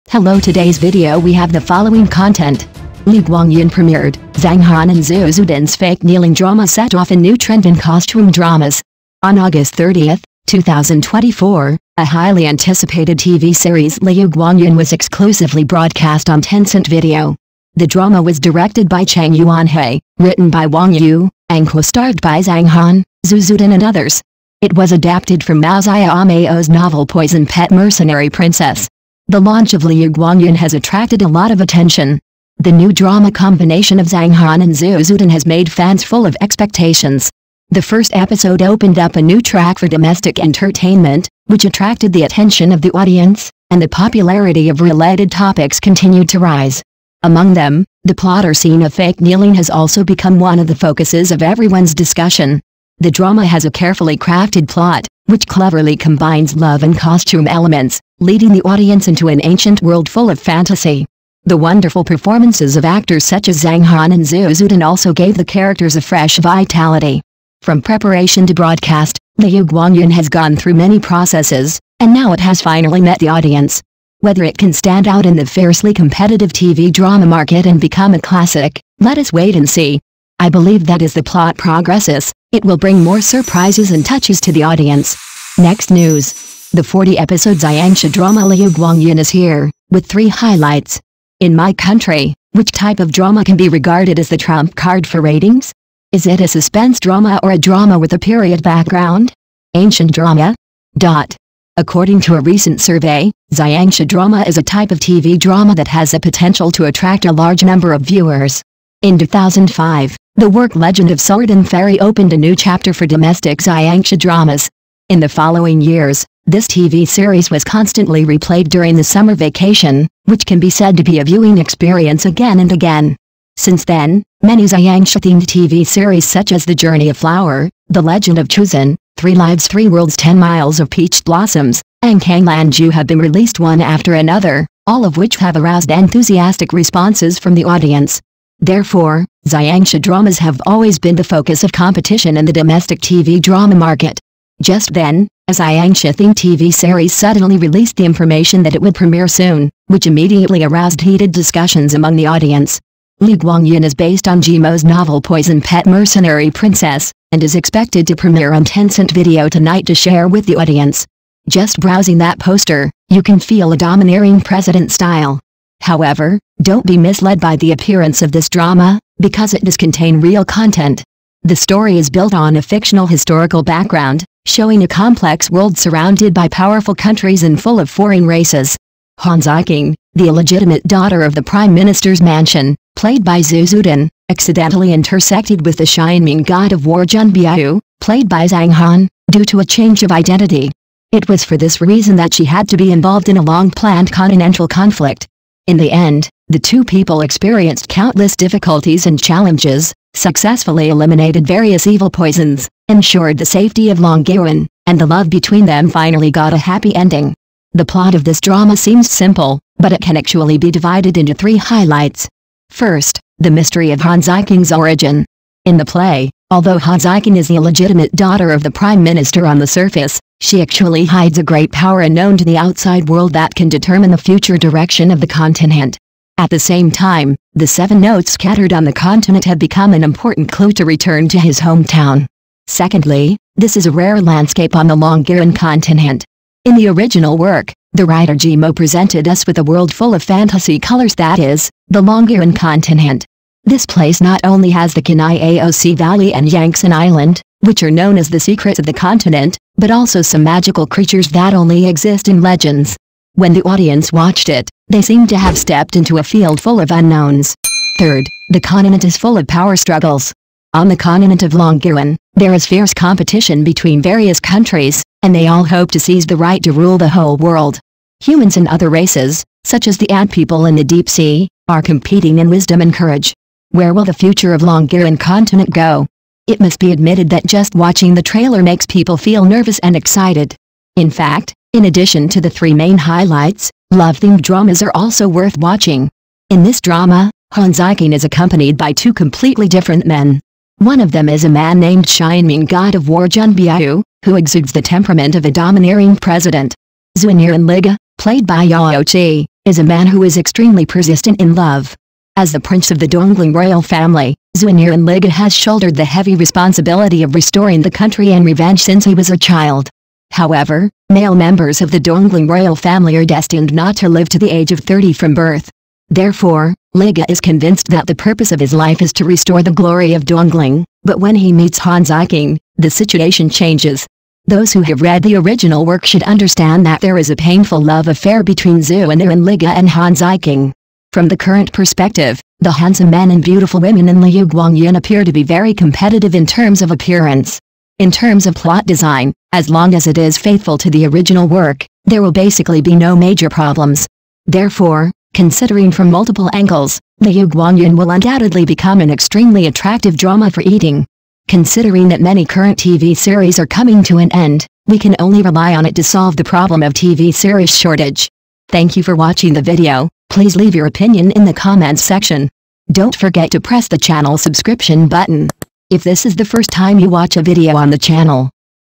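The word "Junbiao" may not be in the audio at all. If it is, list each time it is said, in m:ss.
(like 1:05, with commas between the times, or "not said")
4:53.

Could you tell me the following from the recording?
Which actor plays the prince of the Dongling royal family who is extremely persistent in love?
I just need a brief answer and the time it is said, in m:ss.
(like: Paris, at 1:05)
Yao Chi, at 4:58.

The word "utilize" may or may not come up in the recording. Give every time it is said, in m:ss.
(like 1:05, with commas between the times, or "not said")
not said.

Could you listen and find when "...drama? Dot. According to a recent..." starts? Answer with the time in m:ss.
1:40.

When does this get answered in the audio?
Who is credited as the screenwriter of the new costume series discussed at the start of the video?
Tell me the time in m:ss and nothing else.
0:20.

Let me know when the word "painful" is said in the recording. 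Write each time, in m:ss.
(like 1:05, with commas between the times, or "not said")
5:27.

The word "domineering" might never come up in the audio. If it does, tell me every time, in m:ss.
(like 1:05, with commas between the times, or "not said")
2:43, 4:55.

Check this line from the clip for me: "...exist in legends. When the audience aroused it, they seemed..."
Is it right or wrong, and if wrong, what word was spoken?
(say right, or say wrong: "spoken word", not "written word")
wrong: "watched", not "aroused".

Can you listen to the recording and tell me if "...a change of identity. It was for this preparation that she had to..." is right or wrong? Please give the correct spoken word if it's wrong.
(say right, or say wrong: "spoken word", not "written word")
wrong: "reason", not "preparation".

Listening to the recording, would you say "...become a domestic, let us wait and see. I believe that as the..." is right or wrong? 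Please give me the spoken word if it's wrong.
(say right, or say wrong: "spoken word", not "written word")
wrong: "classic", not "domestic".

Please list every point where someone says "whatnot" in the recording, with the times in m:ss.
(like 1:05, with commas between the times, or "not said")
not said.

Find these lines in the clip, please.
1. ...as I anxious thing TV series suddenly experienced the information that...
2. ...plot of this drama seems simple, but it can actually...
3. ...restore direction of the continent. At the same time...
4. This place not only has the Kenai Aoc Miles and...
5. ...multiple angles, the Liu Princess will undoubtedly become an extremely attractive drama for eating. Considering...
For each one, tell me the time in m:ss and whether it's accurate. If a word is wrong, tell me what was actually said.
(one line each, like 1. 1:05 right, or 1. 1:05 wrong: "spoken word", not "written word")
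1. 2:25 wrong: "released", not "experienced"
2. 3:27 right
3. 3:44 wrong: "future", not "restore"
4. 4:03 wrong: "Valley", not "Miles"
5. 5:46 wrong: "Guangyin", not "Princess".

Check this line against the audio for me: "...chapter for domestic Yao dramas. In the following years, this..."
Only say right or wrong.
wrong.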